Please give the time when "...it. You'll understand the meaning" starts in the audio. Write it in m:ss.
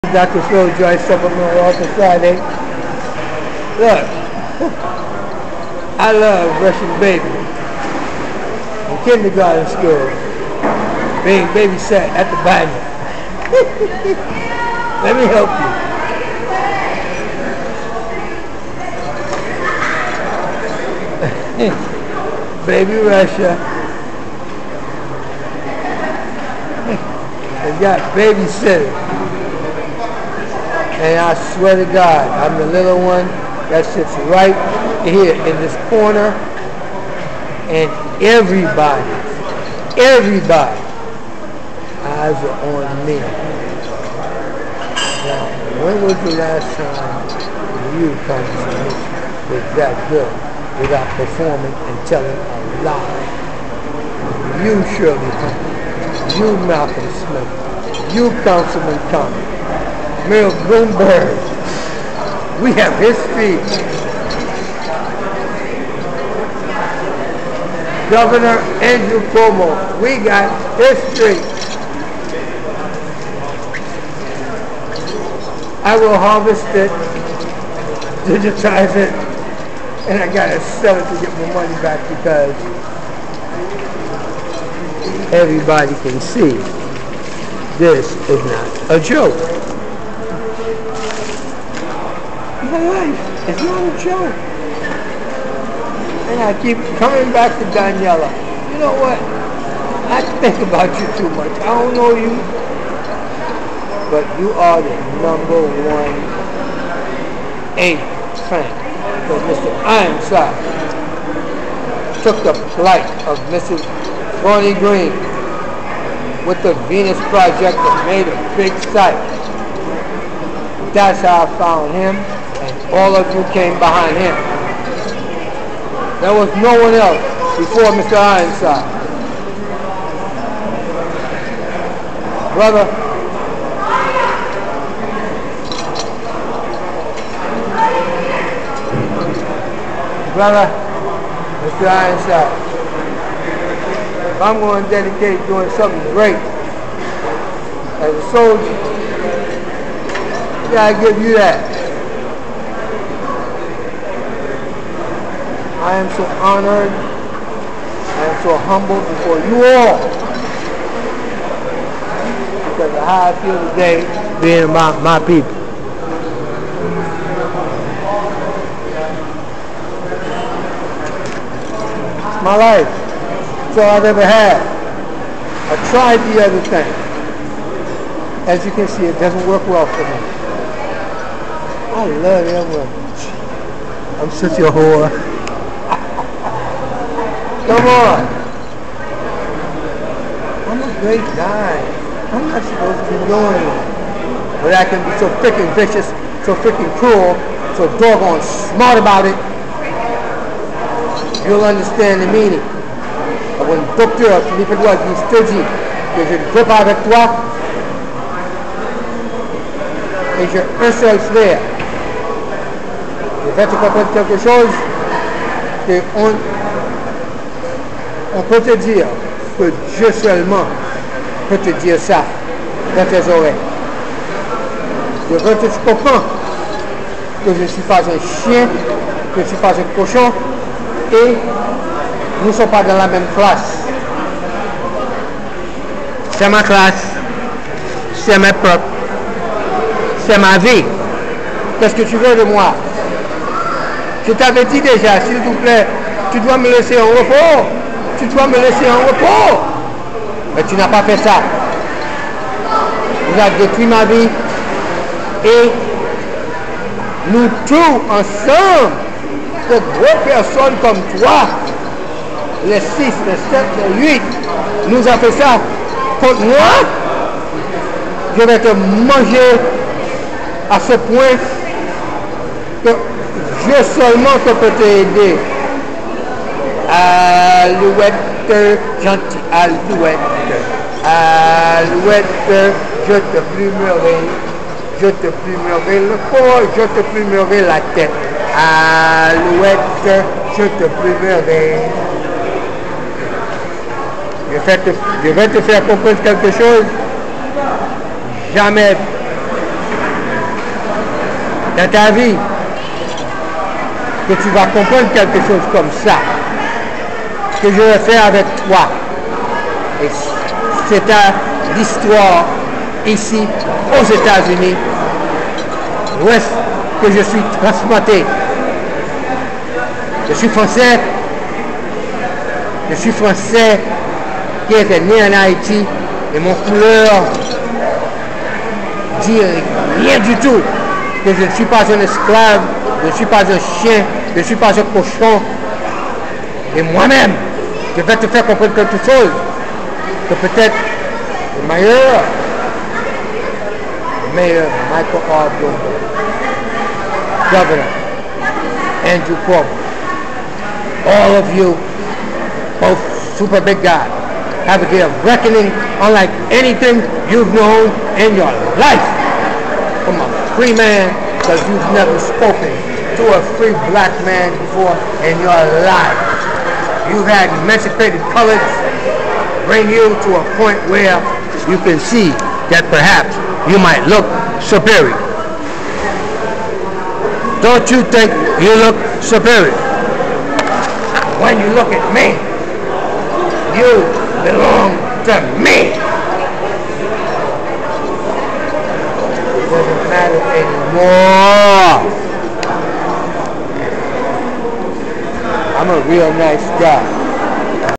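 3:19.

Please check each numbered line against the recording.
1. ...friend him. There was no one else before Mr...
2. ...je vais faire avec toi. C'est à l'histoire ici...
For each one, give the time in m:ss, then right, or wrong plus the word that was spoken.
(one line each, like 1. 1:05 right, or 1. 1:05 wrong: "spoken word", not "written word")
1. 2:03 wrong: "behind", not "friend"
2. 5:07 right.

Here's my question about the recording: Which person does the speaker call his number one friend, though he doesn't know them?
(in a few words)
Daniela.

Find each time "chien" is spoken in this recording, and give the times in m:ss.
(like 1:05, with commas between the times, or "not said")
3:48, 5:33.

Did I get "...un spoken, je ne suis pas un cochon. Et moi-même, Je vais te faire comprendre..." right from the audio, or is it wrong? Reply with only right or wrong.
wrong.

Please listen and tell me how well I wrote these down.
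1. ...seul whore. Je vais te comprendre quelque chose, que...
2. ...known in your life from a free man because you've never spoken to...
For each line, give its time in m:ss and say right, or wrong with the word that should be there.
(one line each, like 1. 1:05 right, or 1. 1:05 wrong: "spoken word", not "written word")
1. 3:30 wrong: "frère", not "whore"
2. 5:57 right.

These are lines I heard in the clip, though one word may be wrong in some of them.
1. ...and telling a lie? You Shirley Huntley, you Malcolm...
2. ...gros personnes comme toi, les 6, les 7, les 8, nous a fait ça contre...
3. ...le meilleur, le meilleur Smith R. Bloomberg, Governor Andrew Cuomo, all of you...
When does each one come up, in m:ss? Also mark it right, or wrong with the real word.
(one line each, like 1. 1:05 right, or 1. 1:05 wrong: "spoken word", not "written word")
1. 0:51 right
2. 4:19 right
3. 5:41 wrong: "Michael", not "Smith".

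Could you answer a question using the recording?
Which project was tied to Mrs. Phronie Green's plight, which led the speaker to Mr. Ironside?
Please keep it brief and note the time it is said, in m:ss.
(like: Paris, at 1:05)
Venus Project, at 1:56.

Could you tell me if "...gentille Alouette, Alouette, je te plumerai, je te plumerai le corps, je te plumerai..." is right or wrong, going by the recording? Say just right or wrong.
right.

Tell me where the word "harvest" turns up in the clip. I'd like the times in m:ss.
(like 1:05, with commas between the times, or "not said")
1:16.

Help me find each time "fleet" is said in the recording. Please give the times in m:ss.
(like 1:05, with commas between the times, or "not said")
not said.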